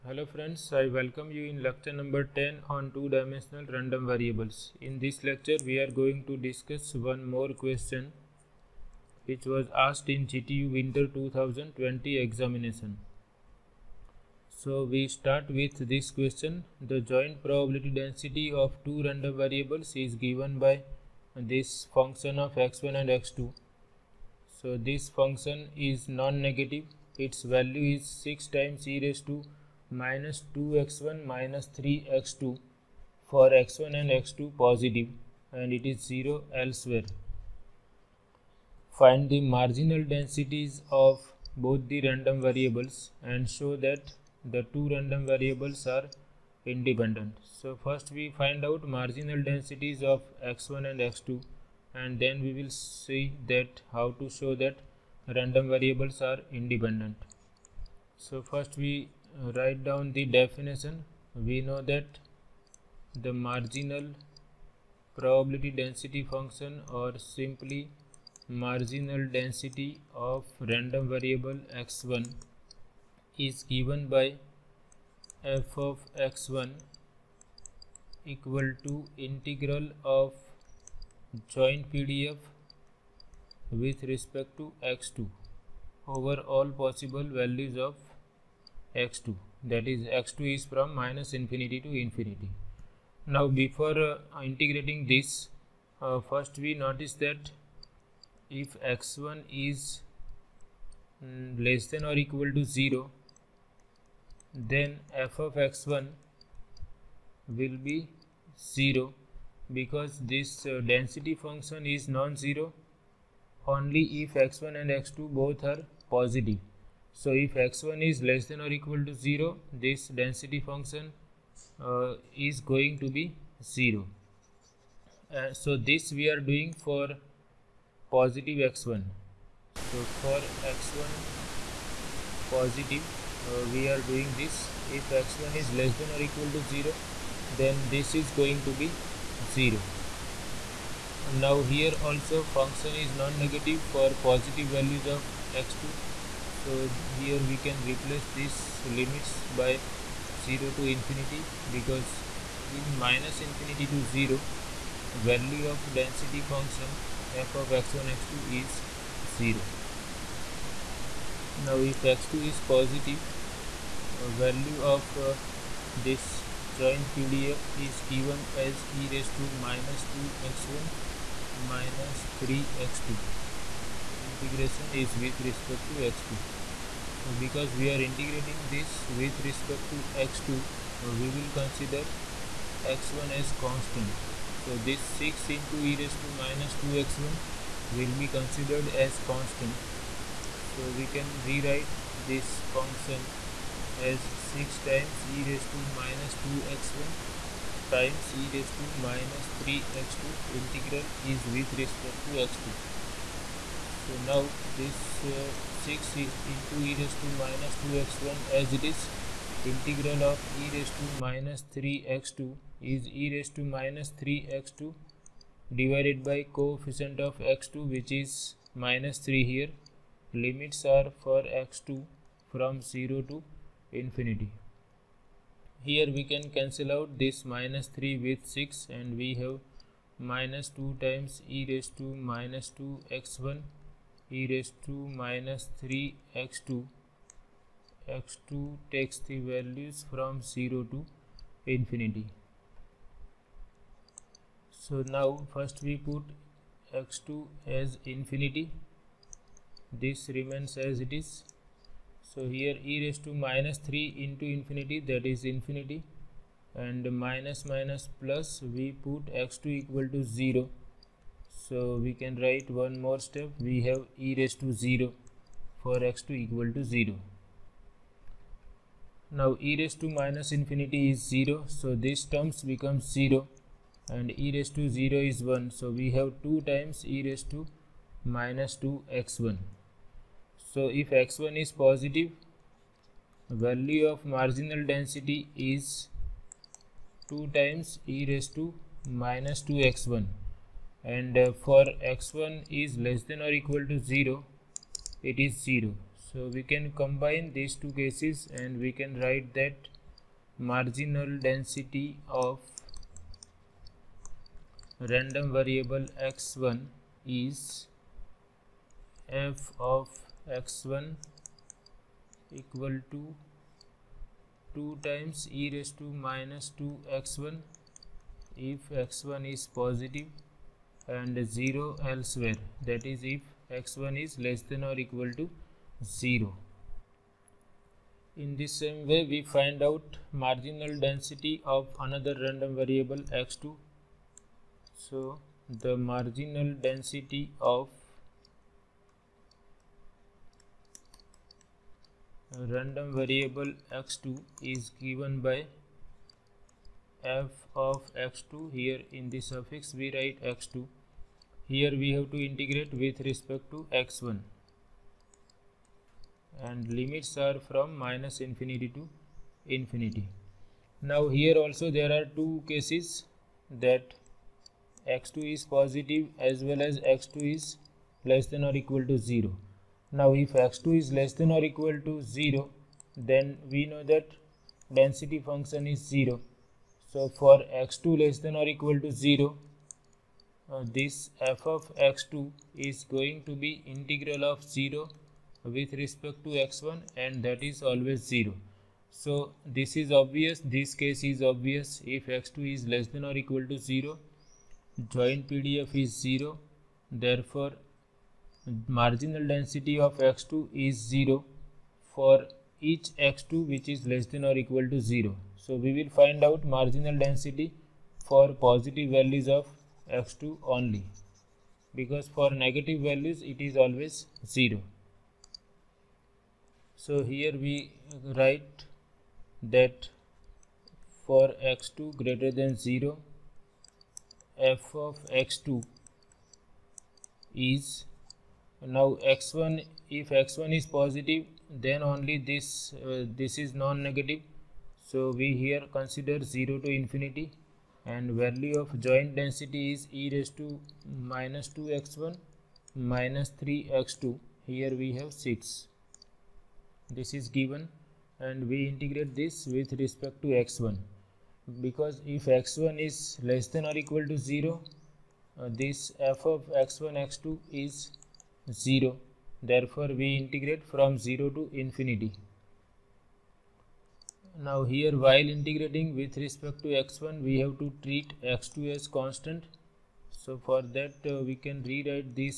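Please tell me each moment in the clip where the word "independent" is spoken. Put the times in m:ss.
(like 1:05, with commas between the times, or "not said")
0:46, 0:56.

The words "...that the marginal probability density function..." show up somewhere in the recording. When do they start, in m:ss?
1:01.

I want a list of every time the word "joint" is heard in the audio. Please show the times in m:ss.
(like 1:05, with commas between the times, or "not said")
0:17, 1:21, 2:46, 6:35, 7:19.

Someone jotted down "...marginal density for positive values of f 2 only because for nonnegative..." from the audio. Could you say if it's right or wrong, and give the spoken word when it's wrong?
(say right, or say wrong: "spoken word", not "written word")
wrong: "negative", not "nonnegative".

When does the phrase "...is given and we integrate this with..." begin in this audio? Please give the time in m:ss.
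7:27.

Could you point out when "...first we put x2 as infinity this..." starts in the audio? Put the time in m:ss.
4:05.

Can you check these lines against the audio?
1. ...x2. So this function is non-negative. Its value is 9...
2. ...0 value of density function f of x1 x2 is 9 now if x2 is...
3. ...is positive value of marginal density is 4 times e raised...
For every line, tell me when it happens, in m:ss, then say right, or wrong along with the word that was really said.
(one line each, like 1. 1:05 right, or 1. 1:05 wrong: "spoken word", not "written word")
1. 0:23 wrong: "6", not "9"
2. 2:34 wrong: "0", not "9"
3. 4:41 wrong: "2", not "4".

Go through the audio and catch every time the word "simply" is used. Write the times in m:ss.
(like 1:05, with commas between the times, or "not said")
1:07.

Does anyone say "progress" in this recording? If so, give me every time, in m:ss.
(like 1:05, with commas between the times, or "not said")
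not said.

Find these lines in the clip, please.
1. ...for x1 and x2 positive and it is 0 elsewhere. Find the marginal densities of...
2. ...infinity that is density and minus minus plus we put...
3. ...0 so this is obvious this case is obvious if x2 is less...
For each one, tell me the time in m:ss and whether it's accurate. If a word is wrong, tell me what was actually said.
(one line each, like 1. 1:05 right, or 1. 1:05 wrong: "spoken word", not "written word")
1. 0:33 right
2. 4:14 wrong: "infinity", not "density"
3. 6:28 right.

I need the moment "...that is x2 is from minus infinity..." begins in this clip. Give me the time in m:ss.
1:29.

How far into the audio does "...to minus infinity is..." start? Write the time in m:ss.
4:30.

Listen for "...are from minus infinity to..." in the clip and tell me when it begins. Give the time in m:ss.
5:57.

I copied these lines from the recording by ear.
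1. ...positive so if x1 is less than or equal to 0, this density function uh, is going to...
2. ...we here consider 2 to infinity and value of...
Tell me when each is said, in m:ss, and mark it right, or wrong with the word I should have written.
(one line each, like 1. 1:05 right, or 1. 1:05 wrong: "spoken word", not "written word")
1. 1:56 right
2. 7:15 wrong: "0", not "2".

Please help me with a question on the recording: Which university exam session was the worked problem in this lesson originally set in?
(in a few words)
GTU Winter 2020.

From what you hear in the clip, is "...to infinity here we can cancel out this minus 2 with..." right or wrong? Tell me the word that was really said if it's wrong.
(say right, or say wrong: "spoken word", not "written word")
wrong: "3", not "2".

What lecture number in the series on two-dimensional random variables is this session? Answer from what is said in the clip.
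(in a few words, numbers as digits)
10.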